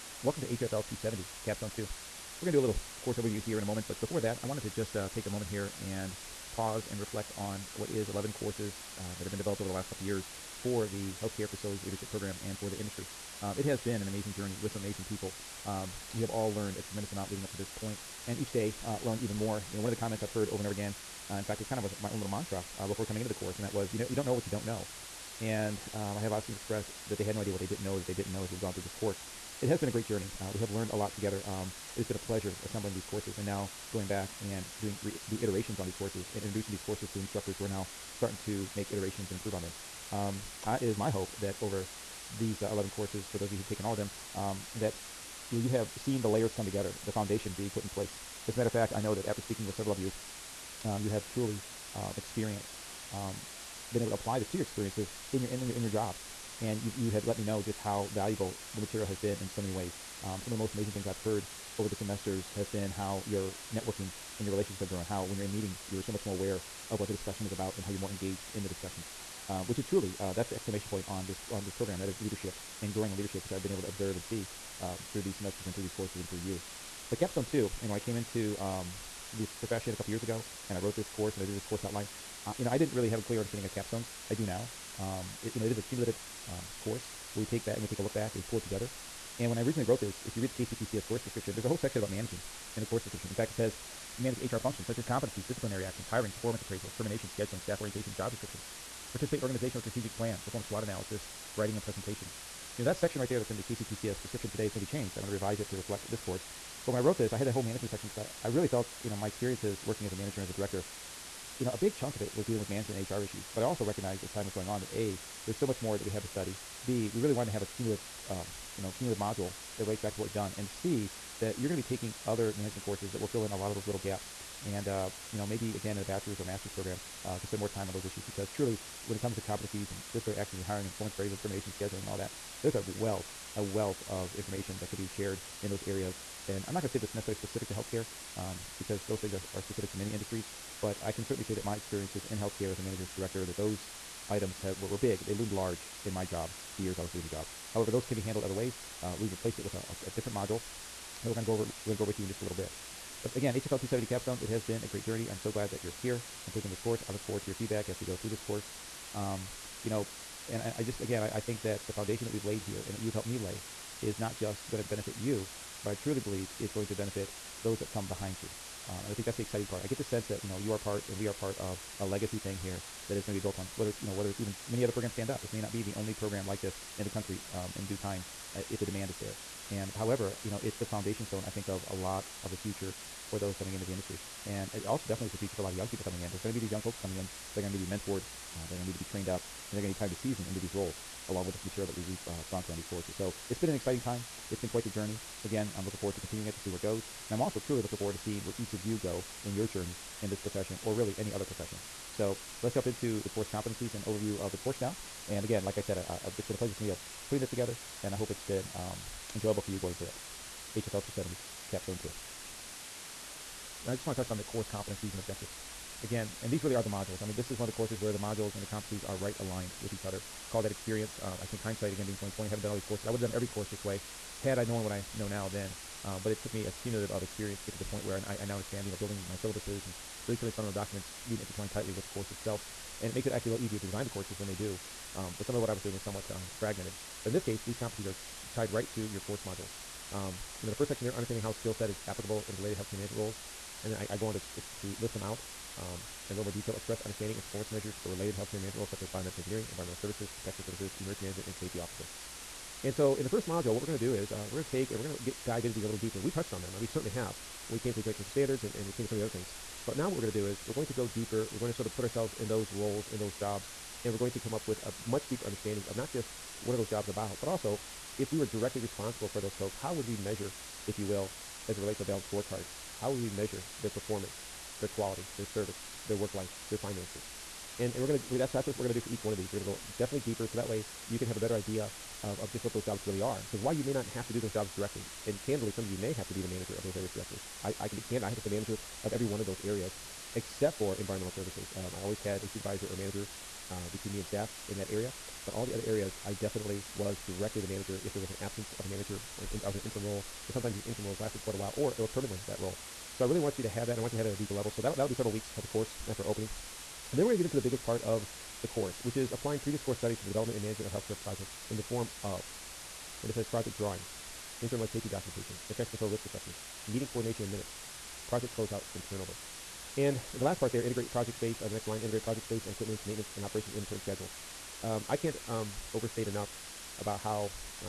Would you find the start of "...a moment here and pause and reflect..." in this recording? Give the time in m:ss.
0:05.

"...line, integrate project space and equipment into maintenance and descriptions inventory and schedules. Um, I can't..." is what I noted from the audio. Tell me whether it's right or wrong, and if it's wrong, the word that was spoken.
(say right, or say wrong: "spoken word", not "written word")
wrong: "operations", not "descriptions".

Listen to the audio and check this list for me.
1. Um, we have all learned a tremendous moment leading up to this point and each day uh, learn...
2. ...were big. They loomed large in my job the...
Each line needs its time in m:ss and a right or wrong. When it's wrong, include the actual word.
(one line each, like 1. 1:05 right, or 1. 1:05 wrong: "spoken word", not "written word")
1. 0:15 wrong: "amount", not "moment"
2. 2:24 right.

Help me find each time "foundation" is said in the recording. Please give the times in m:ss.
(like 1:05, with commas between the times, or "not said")
0:47, 2:41, 3:00.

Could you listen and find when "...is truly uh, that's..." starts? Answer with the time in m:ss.
1:09.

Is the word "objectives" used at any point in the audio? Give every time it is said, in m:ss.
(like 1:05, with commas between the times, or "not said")
3:35.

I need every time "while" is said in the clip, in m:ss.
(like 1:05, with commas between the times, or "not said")
4:43, 5:01.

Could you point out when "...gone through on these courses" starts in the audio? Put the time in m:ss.
3:12.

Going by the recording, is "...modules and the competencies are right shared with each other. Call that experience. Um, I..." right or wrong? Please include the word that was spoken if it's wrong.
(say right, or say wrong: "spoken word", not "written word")
wrong: "aligned", not "shared".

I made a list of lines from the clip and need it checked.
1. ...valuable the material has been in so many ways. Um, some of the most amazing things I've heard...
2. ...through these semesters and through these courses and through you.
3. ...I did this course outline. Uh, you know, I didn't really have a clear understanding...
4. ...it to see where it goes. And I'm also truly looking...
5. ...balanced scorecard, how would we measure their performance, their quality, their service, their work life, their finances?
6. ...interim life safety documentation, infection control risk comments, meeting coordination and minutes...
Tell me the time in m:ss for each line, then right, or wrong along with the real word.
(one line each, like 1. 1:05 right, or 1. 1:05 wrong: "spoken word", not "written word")
1. 0:58 right
2. 1:15 right
3. 1:21 right
4. 3:16 right
5. 4:32 right
6. 5:14 wrong: "assessments", not "comments".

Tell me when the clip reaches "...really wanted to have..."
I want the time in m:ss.
1:57.